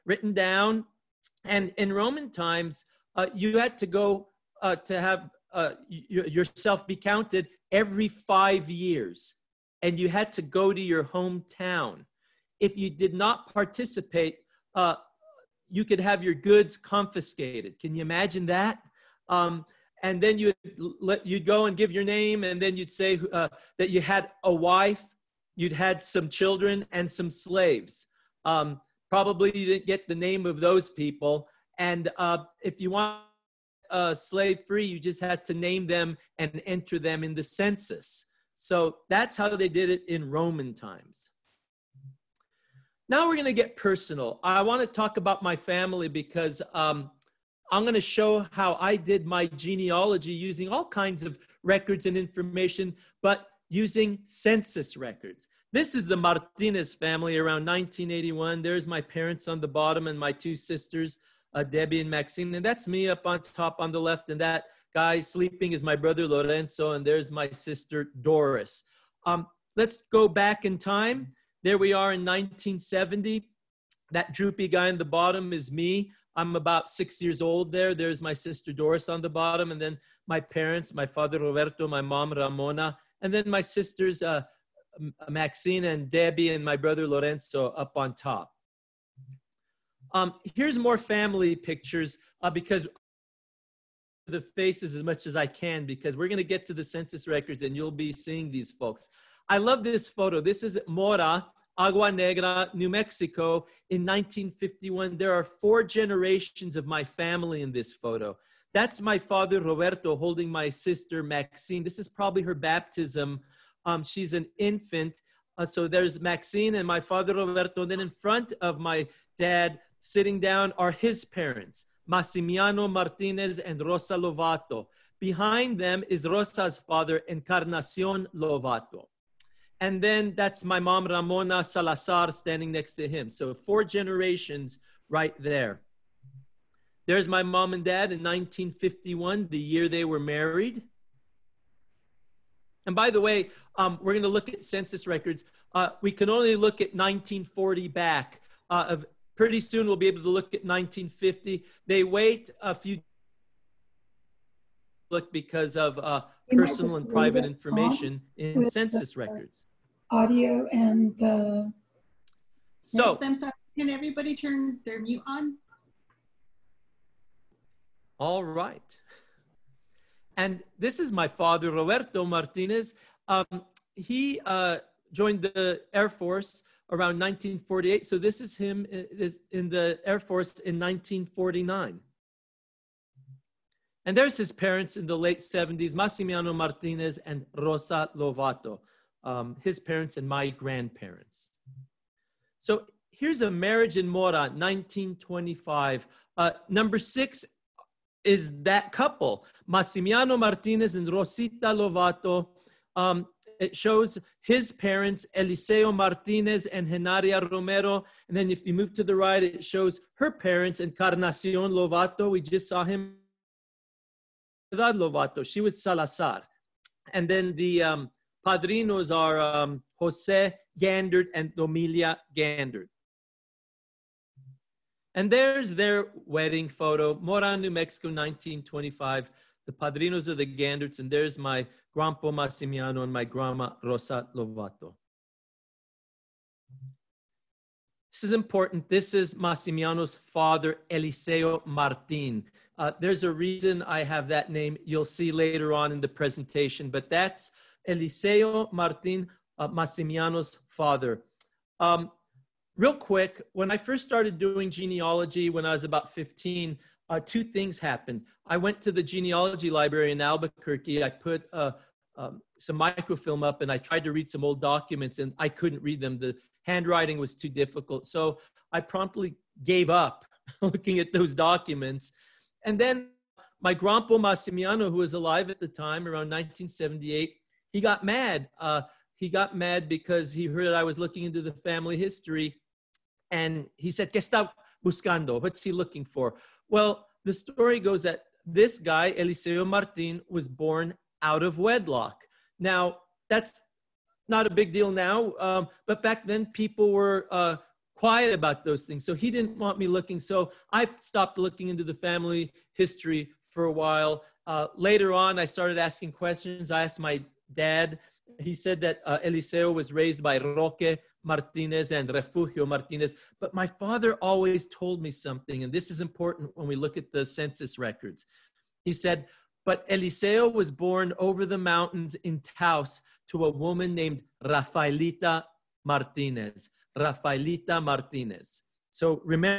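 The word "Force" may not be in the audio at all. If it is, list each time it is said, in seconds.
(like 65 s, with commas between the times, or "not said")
176 s, 180 s.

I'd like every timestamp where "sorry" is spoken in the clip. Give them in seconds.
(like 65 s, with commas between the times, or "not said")
163 s.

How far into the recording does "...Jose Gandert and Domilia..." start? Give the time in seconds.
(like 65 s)
219 s.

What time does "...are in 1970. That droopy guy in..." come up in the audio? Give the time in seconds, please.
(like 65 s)
71 s.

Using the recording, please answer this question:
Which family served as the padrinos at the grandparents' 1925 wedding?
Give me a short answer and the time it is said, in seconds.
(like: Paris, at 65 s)
The Ganderts, at 230 s.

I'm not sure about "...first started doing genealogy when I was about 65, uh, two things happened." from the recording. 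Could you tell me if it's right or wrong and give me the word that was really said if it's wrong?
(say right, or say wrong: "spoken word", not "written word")
wrong: "15", not "65".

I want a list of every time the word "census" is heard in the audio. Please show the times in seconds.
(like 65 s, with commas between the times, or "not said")
37 s, 54 s, 96 s, 144 s, 158 s, 317 s.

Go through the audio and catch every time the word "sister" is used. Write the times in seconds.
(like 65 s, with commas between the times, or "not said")
60 s, 67 s, 78 s, 83 s, 110 s.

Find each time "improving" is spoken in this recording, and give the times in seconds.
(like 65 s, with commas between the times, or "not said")
not said.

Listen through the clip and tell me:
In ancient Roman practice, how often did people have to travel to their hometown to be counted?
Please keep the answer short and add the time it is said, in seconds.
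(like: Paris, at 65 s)
Every 5 years, at 7 s.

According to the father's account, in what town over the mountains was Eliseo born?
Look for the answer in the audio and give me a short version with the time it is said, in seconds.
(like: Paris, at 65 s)
Taos, at 322 s.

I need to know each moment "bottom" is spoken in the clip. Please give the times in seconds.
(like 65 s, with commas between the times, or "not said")
59 s, 75 s, 79 s.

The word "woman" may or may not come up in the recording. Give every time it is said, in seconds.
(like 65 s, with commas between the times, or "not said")
323 s.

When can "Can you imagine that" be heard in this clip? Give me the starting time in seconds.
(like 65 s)
17 s.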